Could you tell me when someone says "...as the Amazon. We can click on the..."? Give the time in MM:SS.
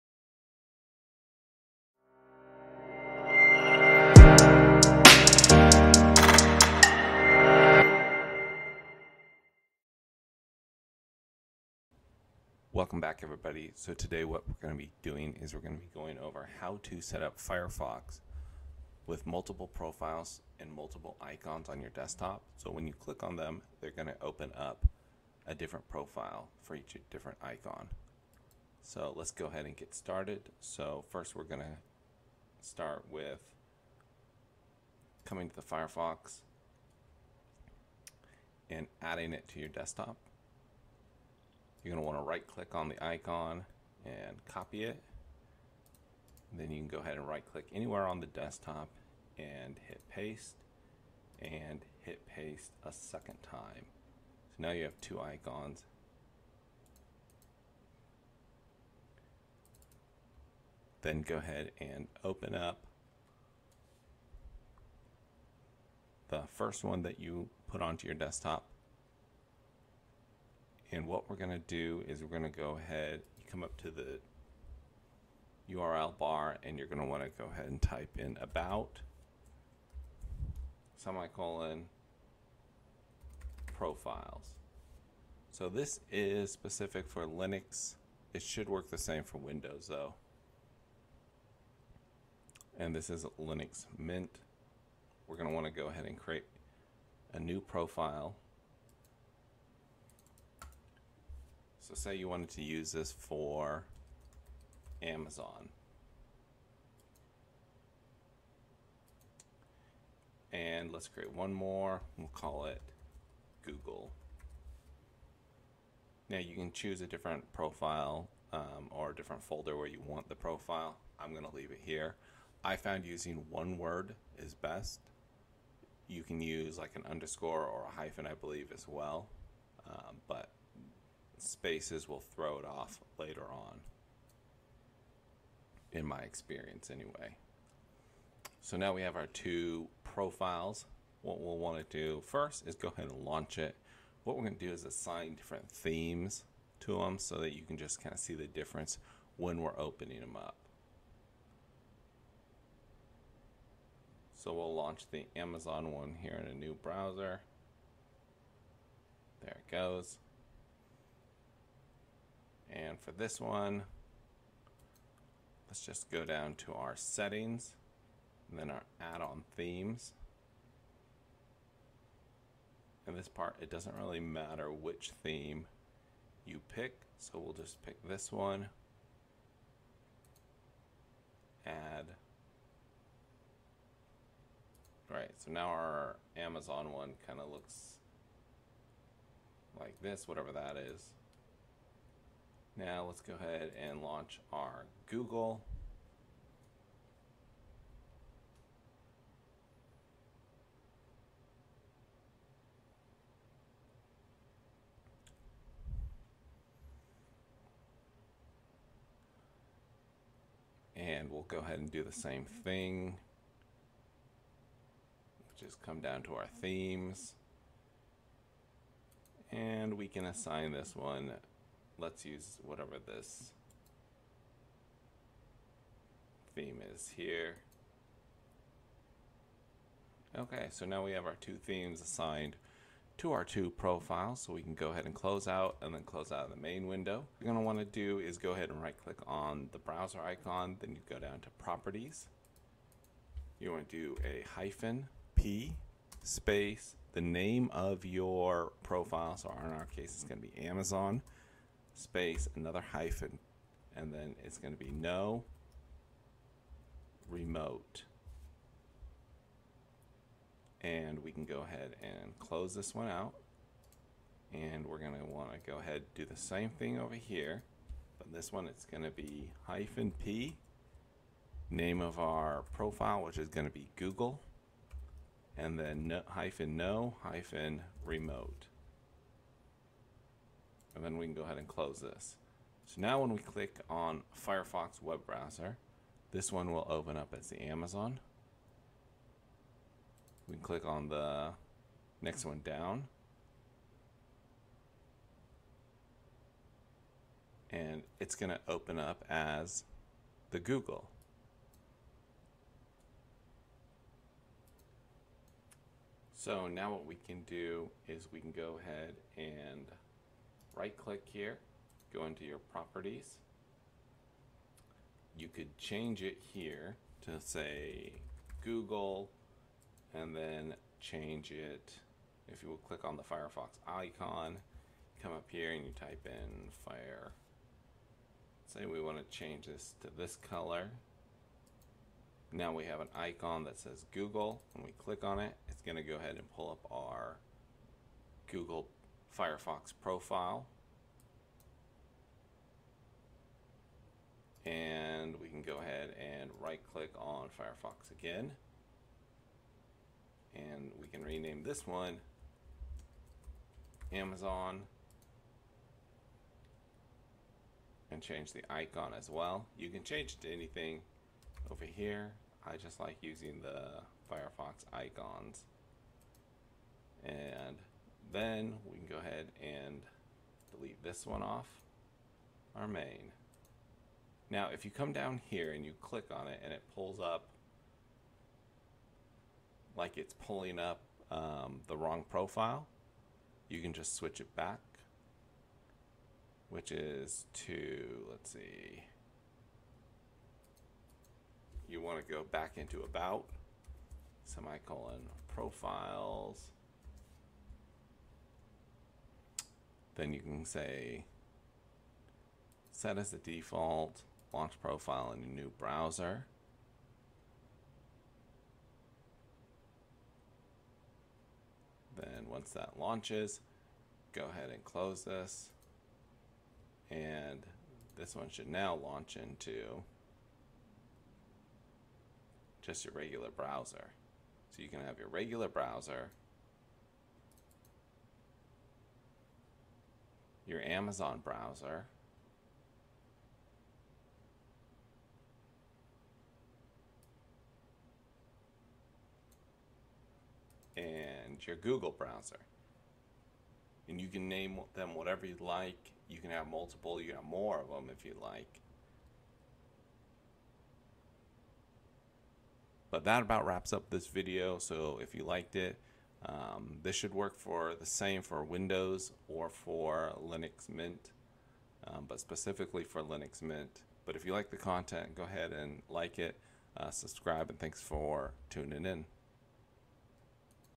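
04:47.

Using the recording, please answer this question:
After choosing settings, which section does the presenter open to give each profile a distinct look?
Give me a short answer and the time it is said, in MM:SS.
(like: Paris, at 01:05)
add-on themes, at 02:48.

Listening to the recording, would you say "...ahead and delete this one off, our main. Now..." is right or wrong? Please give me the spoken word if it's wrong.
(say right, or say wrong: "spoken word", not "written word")
right.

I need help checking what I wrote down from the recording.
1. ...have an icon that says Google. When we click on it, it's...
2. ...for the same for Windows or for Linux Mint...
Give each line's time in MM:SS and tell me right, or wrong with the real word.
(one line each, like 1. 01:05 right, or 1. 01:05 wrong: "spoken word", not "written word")
1. 05:32 right
2. 07:37 right.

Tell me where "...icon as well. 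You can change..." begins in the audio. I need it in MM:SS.
05:58.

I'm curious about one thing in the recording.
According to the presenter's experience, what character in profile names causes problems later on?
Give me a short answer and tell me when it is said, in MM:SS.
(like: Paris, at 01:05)
spaces, at 02:11.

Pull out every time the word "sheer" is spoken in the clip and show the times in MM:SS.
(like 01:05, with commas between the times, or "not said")
not said.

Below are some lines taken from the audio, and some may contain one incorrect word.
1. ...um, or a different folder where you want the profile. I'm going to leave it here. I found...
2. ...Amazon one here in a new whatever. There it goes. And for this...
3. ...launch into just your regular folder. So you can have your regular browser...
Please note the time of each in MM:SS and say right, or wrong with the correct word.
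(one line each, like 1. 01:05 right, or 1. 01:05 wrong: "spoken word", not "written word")
1. 01:58 right
2. 02:35 wrong: "browser", not "whatever"
3. 06:59 wrong: "browser", not "folder".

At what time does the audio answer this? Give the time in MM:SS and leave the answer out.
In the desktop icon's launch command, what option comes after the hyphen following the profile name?
04:14.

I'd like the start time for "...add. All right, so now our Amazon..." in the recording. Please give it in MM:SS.
03:01.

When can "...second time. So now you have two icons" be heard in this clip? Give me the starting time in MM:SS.
00:52.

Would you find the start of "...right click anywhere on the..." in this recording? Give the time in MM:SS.
00:47.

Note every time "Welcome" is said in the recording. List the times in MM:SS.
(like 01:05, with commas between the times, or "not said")
00:12.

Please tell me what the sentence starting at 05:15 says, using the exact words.
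You could change it here to say Google and then change it.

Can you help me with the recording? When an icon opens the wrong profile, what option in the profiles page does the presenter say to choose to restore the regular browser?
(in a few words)
set as the default.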